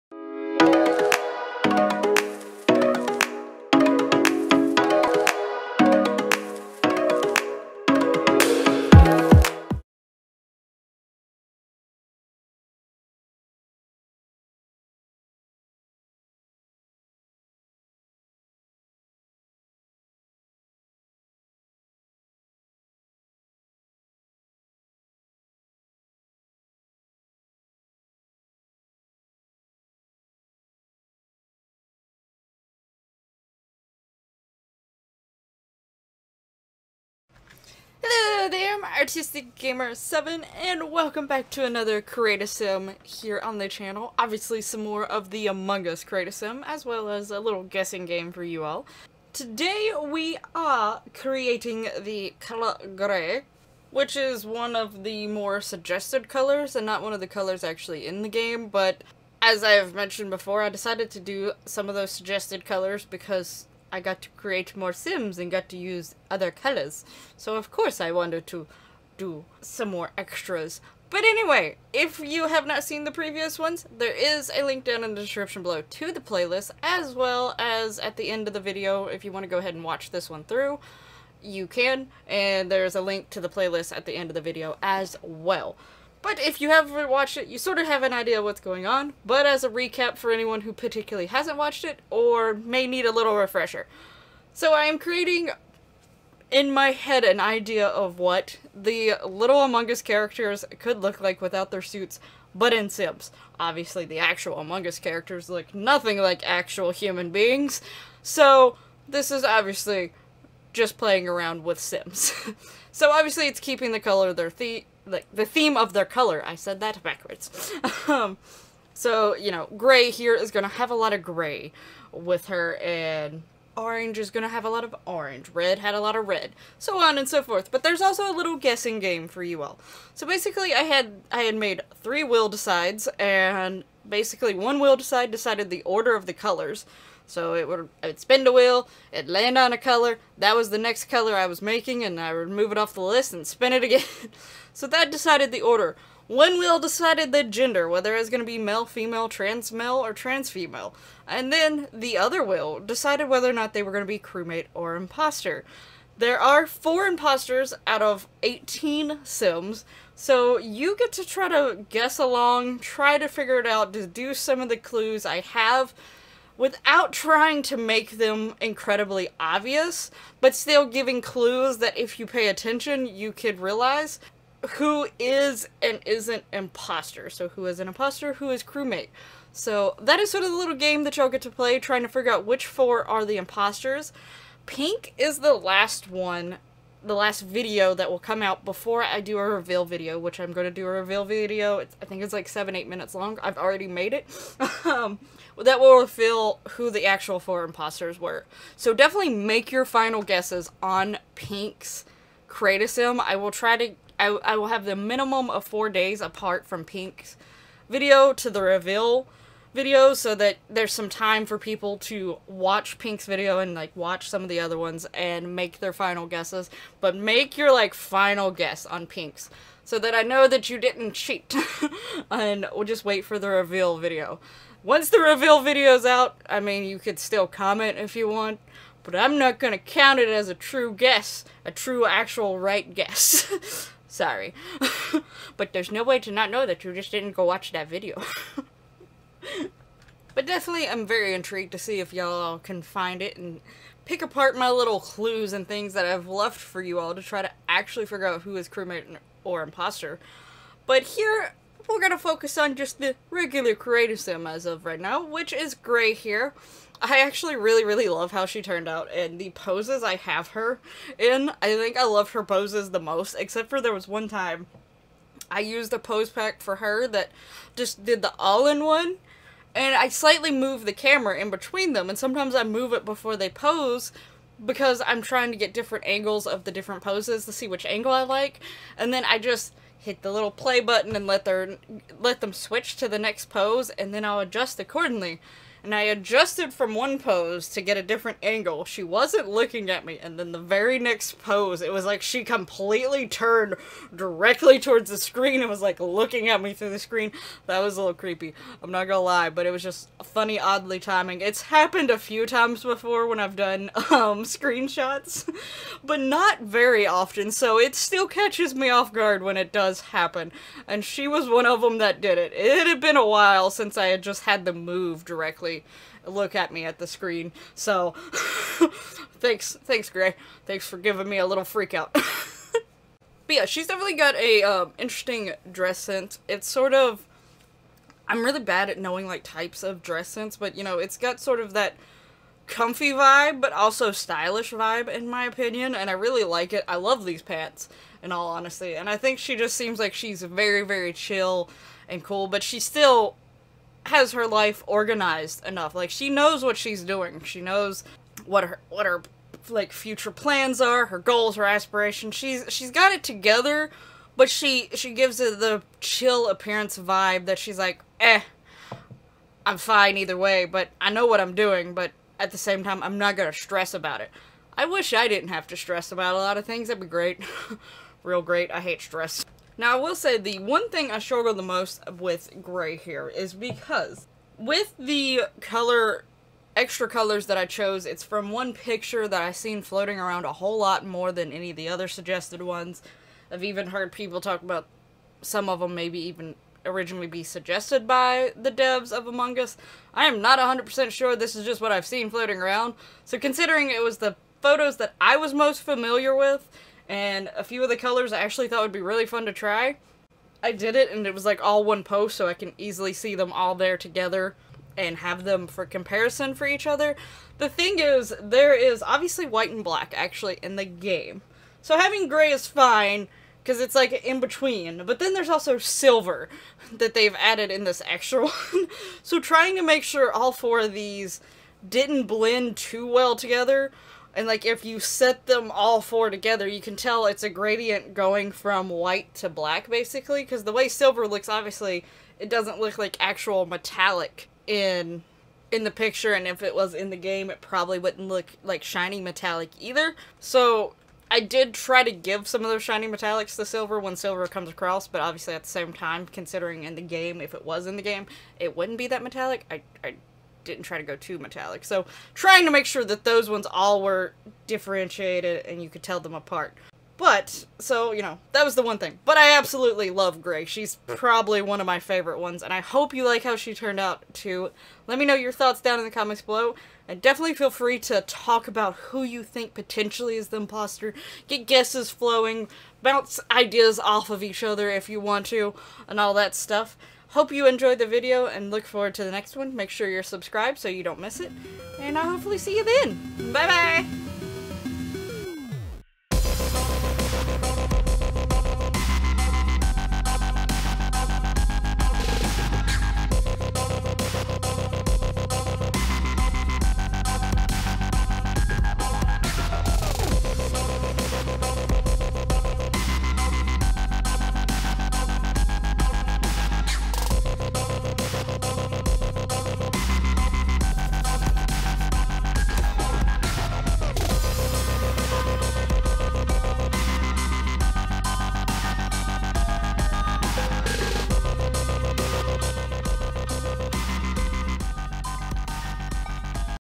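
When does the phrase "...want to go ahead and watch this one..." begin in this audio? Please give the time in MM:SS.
01:19.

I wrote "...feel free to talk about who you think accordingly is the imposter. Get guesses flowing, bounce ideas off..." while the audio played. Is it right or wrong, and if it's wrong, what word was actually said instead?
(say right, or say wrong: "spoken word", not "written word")
wrong: "potentially", not "accordingly".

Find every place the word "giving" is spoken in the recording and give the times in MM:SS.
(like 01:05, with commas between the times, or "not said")
02:50, 05:20.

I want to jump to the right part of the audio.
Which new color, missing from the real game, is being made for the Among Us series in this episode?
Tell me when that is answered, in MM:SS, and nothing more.
00:52.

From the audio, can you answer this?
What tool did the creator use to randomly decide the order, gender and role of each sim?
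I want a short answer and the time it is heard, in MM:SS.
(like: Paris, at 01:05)
Wheel Decide, at 02:12.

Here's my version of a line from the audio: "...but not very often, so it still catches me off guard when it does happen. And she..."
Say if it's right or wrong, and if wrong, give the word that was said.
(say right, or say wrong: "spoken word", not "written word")
right.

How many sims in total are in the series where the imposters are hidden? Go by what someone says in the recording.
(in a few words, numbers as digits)
18.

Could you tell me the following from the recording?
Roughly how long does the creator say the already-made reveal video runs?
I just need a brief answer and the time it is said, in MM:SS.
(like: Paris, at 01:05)
7 or 8 minutes, at 03:12.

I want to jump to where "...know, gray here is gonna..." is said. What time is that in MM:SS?
01:59.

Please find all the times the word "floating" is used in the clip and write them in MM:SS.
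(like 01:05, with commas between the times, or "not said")
06:19, 06:32.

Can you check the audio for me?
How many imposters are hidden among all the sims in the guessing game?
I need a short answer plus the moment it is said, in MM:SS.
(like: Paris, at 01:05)
4, at 02:36.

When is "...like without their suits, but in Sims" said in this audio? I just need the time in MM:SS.
01:41.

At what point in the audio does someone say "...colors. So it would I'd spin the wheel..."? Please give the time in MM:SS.
02:16.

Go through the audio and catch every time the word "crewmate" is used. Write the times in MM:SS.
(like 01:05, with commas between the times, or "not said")
02:34, 02:58, 04:08.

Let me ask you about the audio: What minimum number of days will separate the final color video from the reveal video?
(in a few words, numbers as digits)
4 days.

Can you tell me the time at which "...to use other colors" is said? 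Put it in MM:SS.
01:05.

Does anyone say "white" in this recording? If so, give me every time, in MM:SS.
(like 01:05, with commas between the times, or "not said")
06:49, 07:08.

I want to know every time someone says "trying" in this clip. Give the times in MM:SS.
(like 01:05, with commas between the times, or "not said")
02:47, 03:01, 04:35, 06:59, 07:32.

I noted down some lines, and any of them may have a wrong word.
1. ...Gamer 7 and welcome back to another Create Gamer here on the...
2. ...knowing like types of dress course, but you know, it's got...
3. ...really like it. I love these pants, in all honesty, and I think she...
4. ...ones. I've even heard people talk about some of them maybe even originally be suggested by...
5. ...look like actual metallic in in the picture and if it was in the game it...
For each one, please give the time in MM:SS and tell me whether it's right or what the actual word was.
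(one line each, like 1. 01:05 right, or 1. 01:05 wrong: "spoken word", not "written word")
1. 00:39 wrong: "Sim", not "Gamer"
2. 05:28 wrong: "sense", not "course"
3. 05:36 right
4. 06:22 right
5. 07:12 right.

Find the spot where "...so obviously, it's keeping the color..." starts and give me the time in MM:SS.
01:52.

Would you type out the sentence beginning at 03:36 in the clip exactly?
But make your like final guess on Pink's so that I know that you didn't cheat.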